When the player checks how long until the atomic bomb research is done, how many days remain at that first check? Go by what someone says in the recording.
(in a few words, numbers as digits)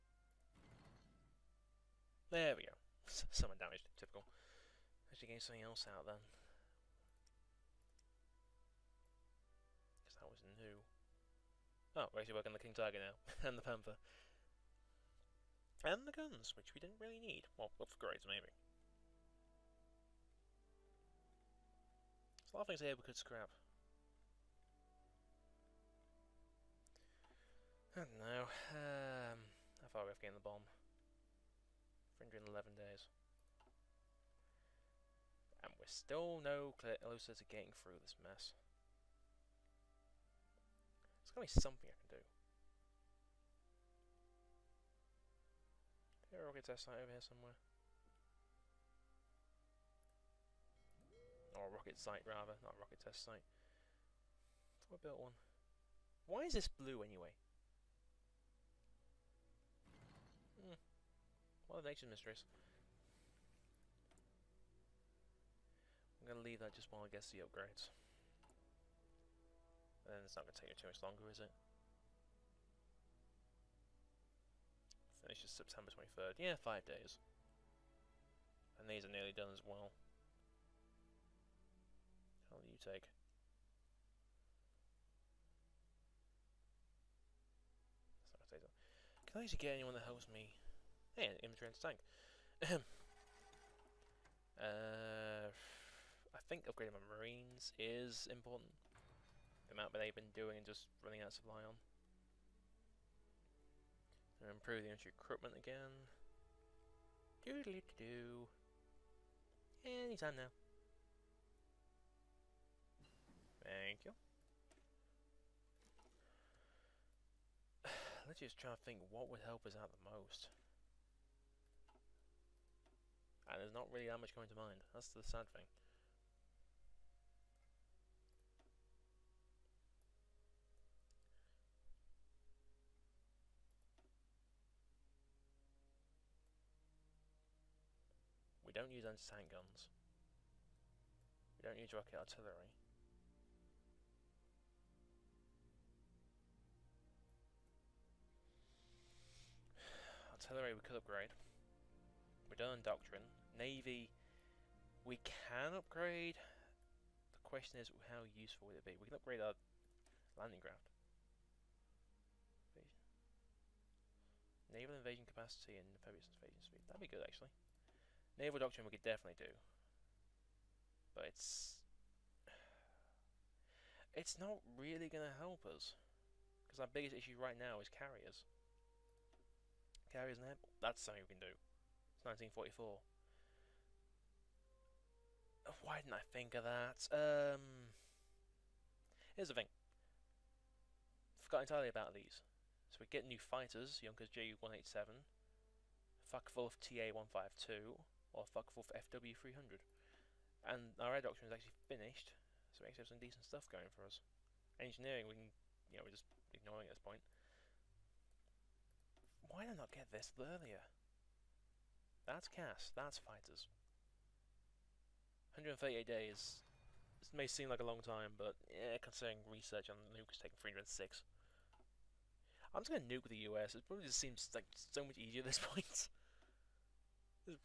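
311.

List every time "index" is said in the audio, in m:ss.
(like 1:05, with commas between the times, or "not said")
not said.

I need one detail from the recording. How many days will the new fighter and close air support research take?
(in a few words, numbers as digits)
138.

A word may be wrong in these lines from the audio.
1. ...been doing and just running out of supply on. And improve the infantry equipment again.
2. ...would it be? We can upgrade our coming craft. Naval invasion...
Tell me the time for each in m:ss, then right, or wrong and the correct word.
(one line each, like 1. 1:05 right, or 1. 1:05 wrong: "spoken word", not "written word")
1. 1:40 right
2. 2:38 wrong: "landing", not "coming".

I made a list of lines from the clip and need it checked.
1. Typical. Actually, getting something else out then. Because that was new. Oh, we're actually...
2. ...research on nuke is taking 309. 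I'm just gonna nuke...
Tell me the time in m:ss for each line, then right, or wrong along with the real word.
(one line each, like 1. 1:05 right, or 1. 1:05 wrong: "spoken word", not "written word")
1. 0:03 right
2. 3:39 wrong: "306", not "309".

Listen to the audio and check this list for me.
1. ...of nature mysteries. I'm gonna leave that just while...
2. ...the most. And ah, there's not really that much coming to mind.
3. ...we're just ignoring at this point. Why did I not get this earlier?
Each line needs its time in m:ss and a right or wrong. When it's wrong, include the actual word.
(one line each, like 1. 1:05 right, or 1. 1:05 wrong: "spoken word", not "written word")
1. 1:01 right
2. 1:59 right
3. 3:26 right.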